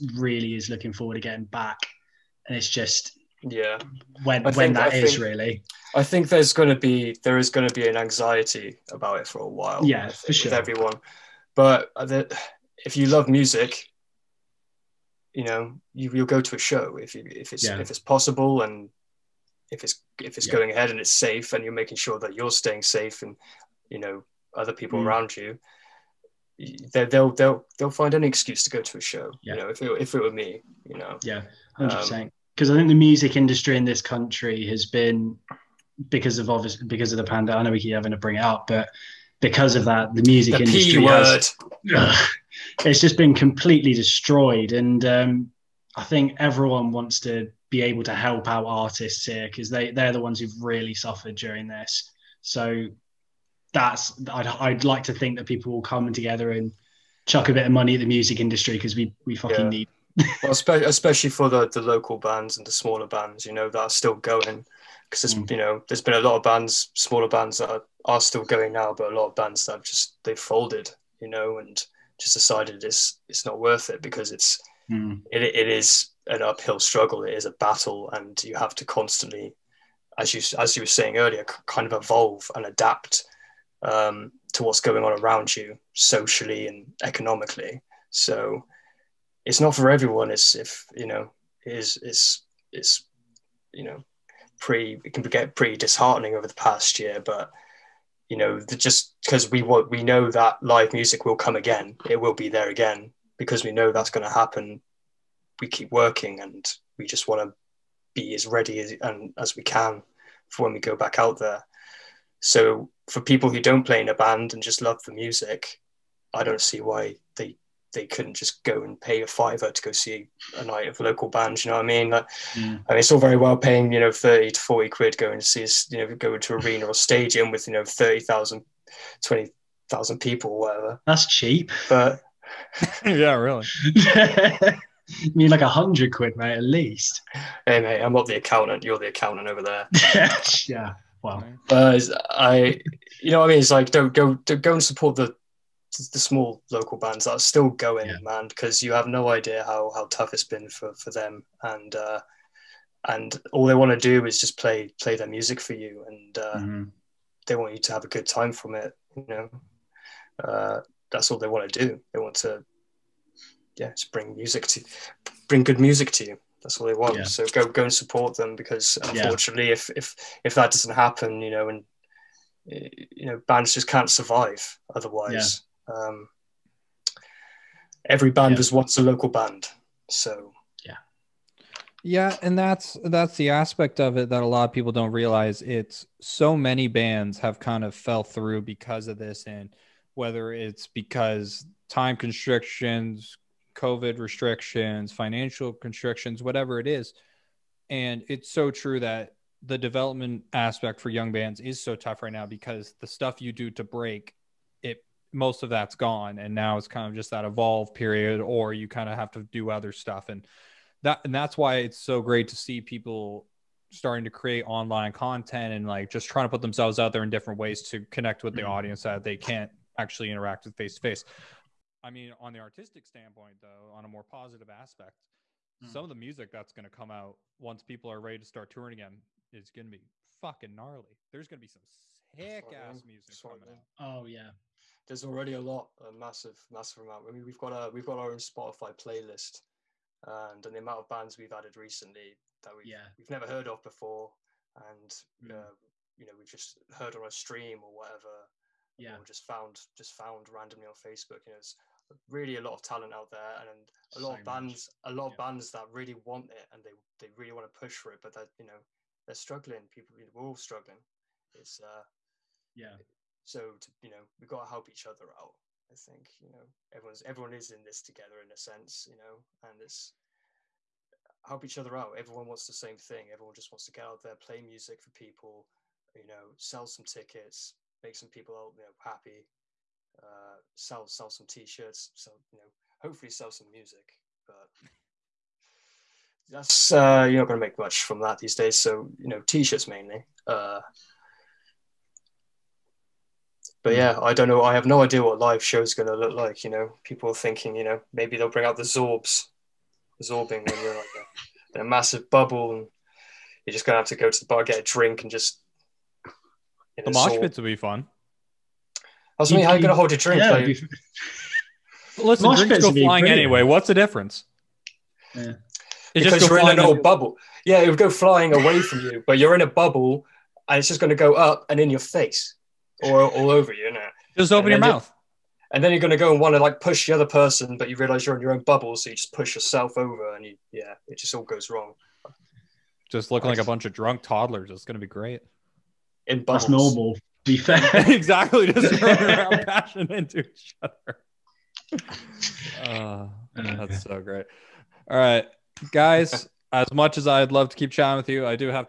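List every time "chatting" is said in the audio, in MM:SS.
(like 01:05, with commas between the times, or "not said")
05:47.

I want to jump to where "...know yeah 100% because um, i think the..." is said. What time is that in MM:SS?
00:30.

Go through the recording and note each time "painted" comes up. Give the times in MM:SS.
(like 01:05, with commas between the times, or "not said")
not said.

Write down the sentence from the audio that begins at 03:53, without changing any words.
oh yeah there's already a lot, a massive, massive amount.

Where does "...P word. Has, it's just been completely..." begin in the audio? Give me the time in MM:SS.
00:40.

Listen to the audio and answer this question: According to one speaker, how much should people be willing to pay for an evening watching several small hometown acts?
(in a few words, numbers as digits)
a fiver.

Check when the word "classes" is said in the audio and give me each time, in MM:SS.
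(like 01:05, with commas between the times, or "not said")
not said.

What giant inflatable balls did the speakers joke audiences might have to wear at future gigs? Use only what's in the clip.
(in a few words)
Zorbs.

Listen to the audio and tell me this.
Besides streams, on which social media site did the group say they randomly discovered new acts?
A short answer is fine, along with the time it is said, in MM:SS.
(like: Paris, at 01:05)
Facebook, at 04:10.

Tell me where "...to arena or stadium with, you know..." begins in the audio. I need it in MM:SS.
02:06.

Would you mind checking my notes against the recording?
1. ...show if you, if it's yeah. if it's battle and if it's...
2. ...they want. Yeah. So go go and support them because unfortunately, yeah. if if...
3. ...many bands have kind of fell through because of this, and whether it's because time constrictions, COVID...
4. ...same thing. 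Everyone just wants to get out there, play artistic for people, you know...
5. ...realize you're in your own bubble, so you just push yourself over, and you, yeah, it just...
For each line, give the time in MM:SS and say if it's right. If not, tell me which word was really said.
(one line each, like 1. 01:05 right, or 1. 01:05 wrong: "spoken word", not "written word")
1. 00:16 wrong: "possible", not "battle"
2. 02:46 right
3. 03:06 right
4. 04:32 wrong: "music", not "artistic"
5. 05:27 right.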